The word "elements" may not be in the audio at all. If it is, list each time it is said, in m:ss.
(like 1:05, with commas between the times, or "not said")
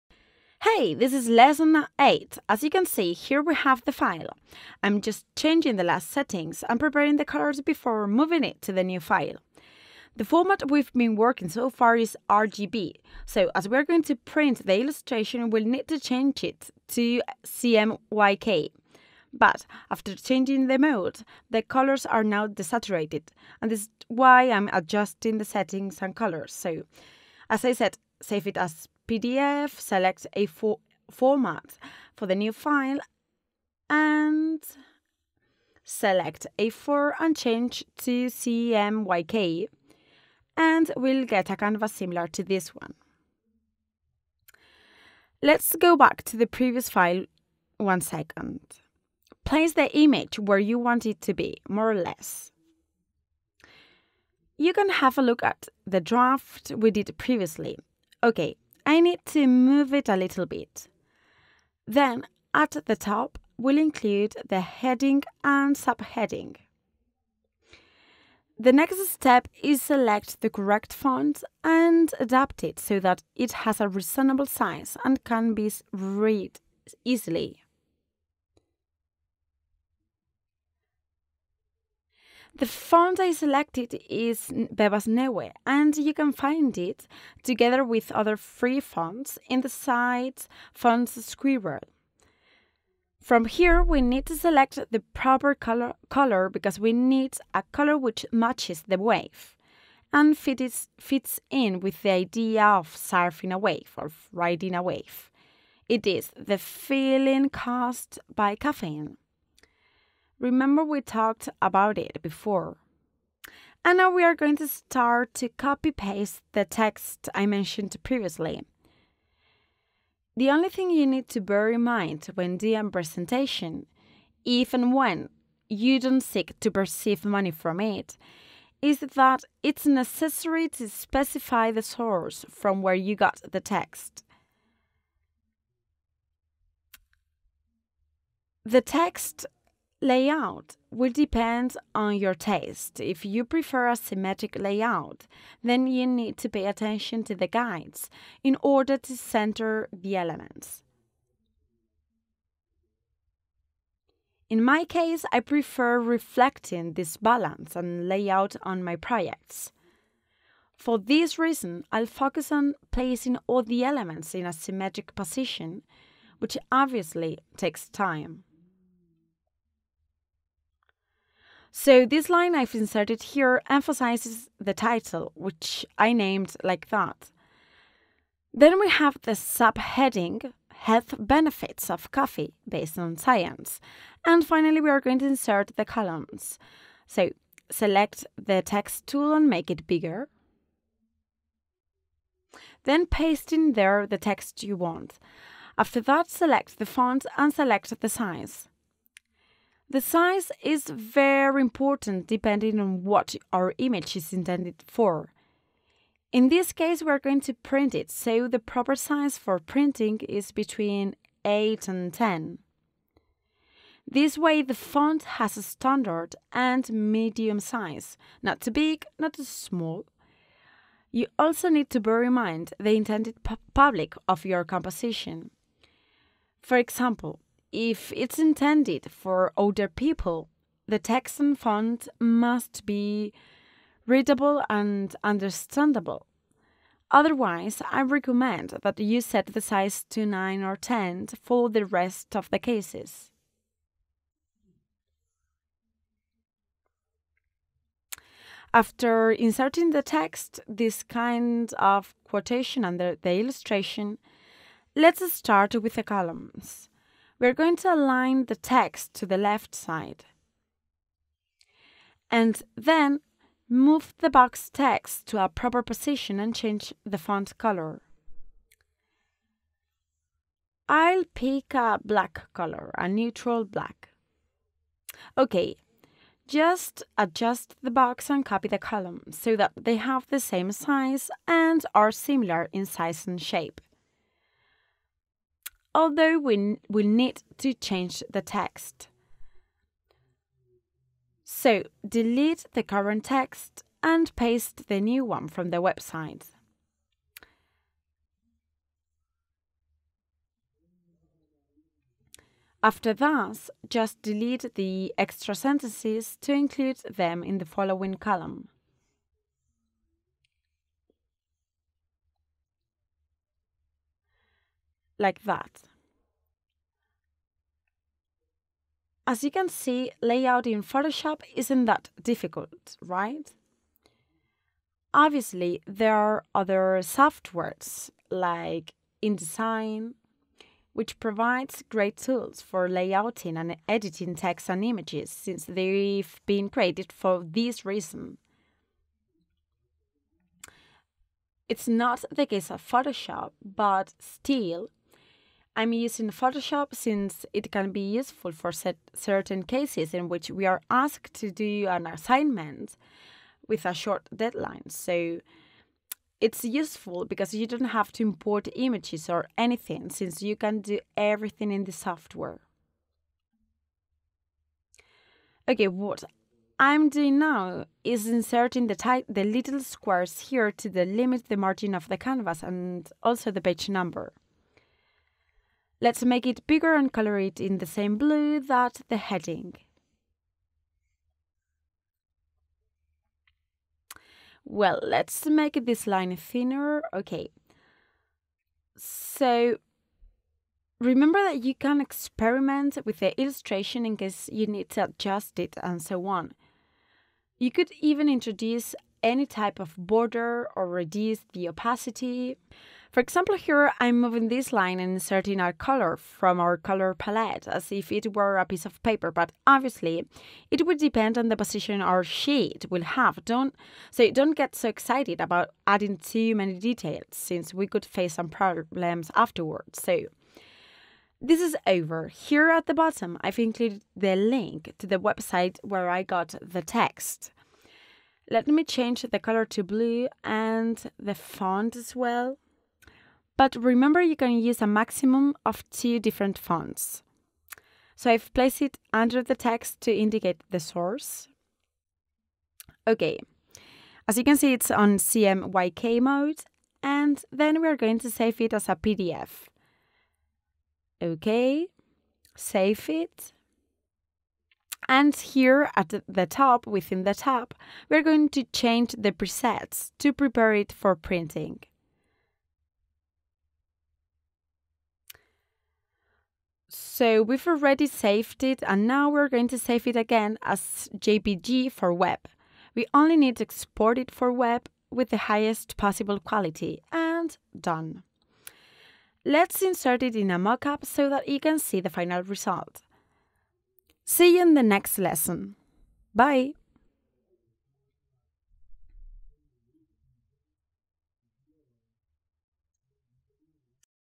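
2:30, 2:43.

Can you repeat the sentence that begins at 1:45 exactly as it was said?
It is the feeling caused by caffeine.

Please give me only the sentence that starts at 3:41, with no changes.
You also need to bear in mind the intended pu public of your composition.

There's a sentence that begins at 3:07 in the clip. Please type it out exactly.
So select the text tool and make it bigger.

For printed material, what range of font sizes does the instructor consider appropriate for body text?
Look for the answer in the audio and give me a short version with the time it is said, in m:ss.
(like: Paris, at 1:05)
8 to 10, at 3:30.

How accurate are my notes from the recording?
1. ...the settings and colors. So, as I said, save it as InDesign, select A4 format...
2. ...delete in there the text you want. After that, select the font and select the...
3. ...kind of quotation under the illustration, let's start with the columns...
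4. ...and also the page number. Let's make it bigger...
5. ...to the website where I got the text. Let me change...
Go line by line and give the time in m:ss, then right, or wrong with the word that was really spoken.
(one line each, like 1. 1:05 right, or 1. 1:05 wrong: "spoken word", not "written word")
1. 0:25 wrong: "PDF", not "InDesign"
2. 3:13 wrong: "paste", not "delete"
3. 4:11 right
4. 6:12 right
5. 7:04 right.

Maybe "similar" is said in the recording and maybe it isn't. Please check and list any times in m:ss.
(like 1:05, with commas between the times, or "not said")
0:41, 4:42.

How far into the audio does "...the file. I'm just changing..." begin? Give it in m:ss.
0:03.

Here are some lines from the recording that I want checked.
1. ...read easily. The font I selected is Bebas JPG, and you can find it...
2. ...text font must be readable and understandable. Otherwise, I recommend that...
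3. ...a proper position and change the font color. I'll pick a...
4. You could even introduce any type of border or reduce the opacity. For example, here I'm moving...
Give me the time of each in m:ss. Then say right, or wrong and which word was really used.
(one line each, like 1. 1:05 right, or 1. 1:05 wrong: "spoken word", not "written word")
1. 1:15 wrong: "Neue", not "JPG"
2. 3:50 right
3. 4:25 right
4. 6:37 right.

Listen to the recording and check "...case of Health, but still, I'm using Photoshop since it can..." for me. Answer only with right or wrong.
wrong.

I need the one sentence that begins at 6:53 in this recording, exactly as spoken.
Don't so don't get so excited about adding too many details since we could face some problems afterwards.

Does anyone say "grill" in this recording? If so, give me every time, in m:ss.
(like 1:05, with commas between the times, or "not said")
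not said.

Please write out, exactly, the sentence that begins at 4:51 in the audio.
So delete the current text and paste the new one from the website.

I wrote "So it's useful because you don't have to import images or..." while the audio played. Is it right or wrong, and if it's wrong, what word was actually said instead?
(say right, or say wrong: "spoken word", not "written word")
right.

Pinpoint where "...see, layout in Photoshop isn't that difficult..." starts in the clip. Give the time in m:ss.
5:19.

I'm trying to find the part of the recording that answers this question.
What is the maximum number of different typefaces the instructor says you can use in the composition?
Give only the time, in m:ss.
7:15.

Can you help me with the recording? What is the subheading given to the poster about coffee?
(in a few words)
Health Benefits of Coffee.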